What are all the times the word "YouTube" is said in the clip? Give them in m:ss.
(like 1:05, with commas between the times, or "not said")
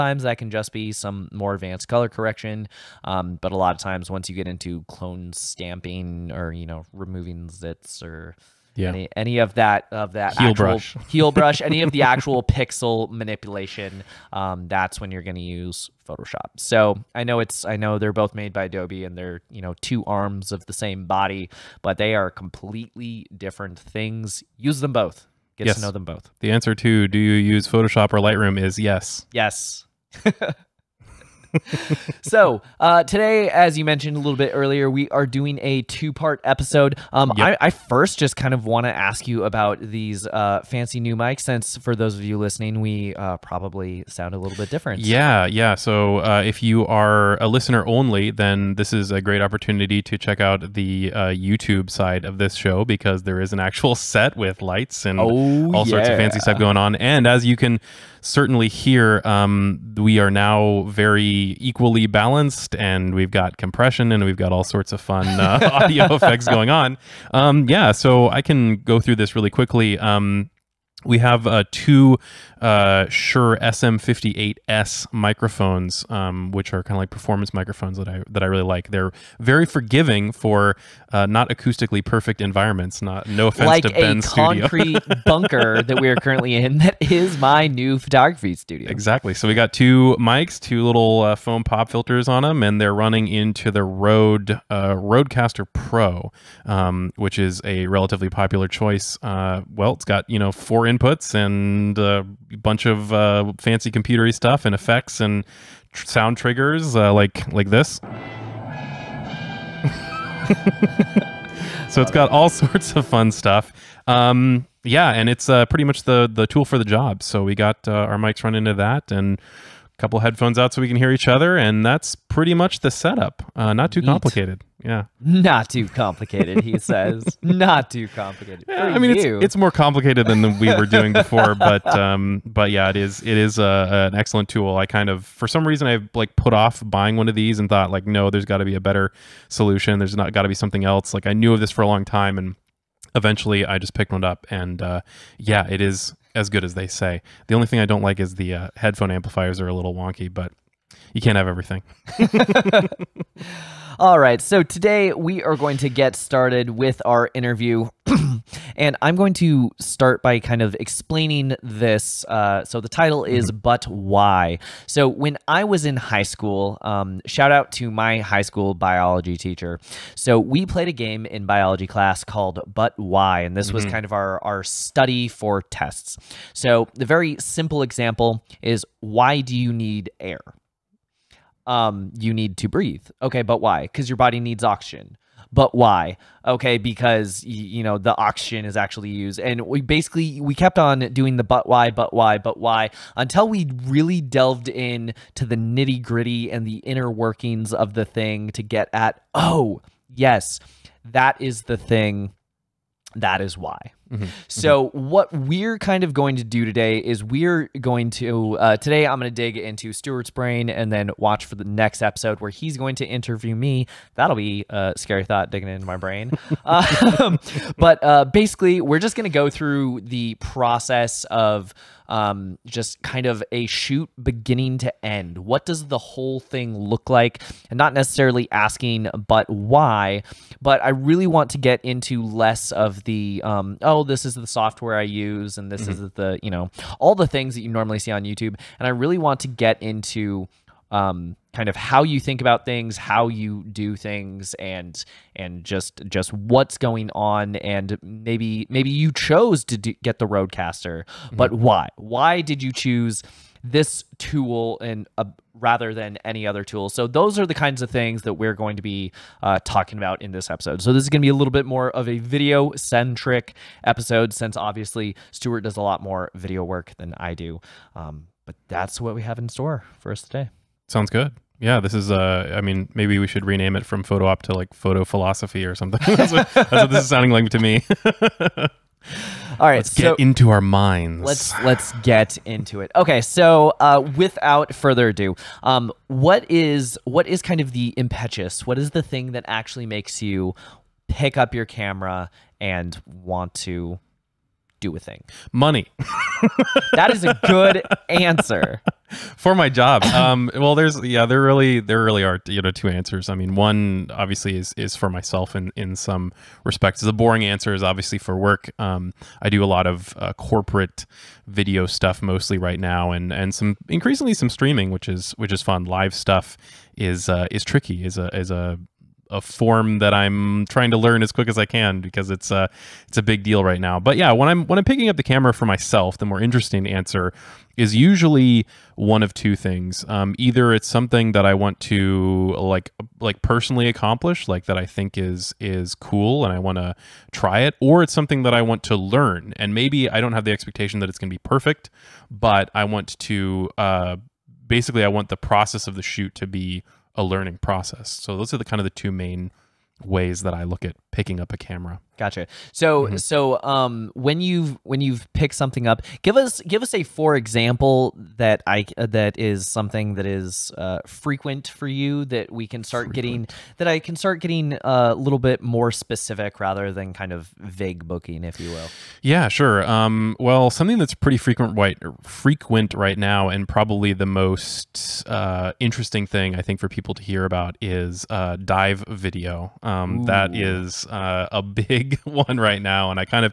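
0:51, 3:58.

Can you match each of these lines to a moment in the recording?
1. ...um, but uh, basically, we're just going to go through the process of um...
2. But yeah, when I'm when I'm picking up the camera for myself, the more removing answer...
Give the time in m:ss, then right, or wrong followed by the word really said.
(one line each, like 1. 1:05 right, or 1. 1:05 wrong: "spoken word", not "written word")
1. 3:36 right
2. 5:23 wrong: "interesting", not "removing".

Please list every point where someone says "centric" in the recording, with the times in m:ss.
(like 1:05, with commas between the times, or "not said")
4:22.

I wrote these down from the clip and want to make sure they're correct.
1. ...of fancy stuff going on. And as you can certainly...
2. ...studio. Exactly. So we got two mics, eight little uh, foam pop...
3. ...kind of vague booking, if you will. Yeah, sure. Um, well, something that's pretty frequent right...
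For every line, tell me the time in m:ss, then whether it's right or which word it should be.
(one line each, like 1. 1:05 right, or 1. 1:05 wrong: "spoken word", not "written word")
1. 0:56 right
2. 1:28 wrong: "two", not "eight"
3. 6:07 right.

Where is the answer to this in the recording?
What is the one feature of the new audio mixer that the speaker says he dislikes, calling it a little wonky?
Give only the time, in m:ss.
2:28.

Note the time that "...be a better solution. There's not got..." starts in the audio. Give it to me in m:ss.
2:18.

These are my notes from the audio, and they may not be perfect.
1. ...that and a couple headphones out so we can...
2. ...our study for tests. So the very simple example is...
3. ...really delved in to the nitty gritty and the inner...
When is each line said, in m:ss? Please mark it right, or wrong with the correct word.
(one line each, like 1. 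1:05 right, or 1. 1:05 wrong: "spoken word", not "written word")
1. 1:58 right
2. 2:54 right
3. 3:13 right.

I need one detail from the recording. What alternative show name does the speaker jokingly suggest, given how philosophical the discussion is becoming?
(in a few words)
Photo Philosophy.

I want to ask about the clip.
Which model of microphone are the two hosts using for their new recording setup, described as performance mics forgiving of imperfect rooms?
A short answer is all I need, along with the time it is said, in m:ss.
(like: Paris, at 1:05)
Shure SM58, at 1:13.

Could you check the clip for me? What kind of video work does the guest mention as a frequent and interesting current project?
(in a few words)
Dive video.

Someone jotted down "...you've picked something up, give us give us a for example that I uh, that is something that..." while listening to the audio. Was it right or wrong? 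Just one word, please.
right.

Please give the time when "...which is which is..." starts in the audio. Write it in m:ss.
5:14.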